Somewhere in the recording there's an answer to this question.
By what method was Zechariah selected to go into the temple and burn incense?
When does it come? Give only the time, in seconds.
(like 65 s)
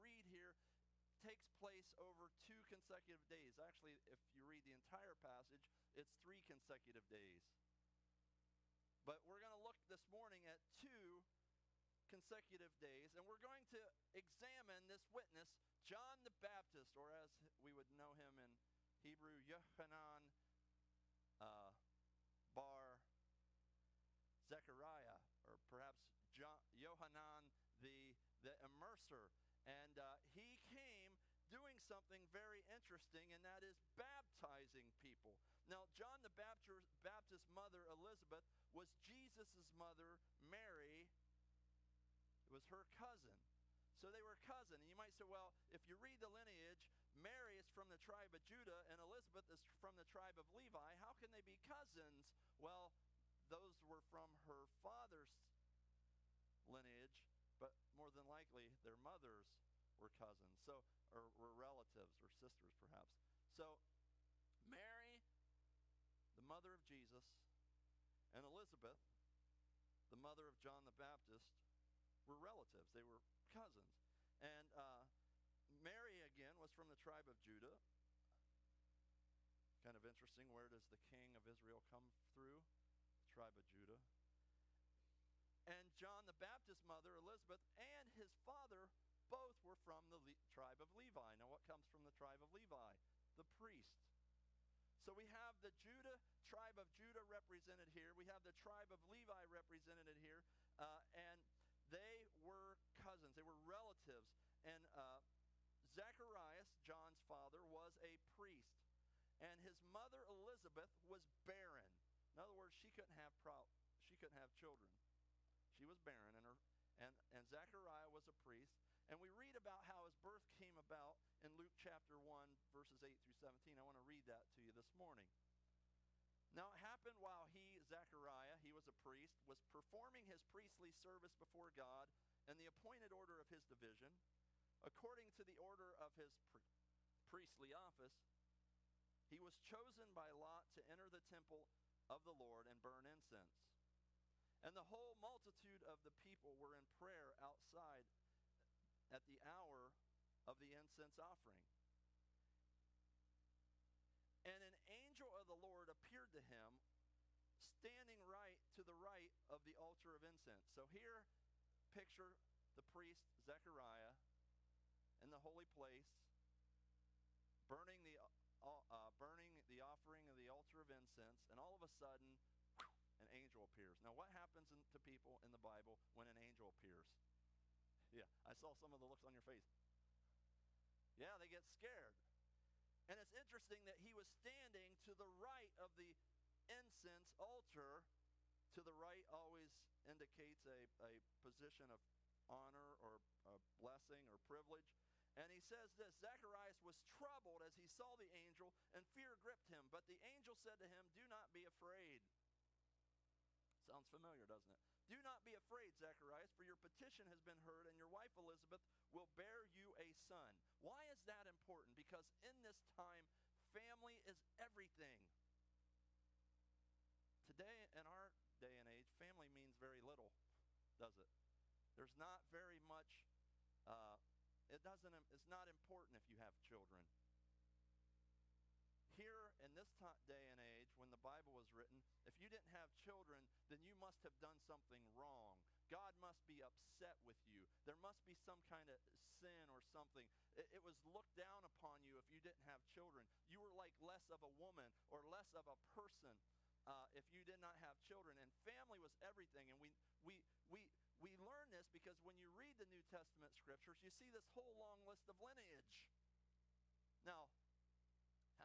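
140 s.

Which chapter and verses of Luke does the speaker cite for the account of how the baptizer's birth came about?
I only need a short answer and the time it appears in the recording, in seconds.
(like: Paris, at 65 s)
Luke 1:8-17, at 121 s.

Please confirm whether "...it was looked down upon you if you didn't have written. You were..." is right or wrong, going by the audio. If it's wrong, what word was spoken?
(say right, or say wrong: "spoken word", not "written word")
wrong: "children", not "written".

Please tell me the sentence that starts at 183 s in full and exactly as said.
And it's interesting that he was standing to the right of the incense altar.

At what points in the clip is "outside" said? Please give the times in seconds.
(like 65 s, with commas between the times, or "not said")
147 s.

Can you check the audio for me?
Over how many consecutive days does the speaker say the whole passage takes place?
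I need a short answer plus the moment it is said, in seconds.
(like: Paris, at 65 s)
3, at 6 s.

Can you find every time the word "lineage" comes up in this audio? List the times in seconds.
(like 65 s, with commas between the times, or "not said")
46 s, 56 s, 255 s.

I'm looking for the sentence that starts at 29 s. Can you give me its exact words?
And uh, he came doing something very interesting, and that is baptizing people.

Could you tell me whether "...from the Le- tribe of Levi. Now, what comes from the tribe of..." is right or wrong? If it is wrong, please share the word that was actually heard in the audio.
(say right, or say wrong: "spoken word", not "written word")
right.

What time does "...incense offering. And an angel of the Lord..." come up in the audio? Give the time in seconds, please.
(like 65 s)
150 s.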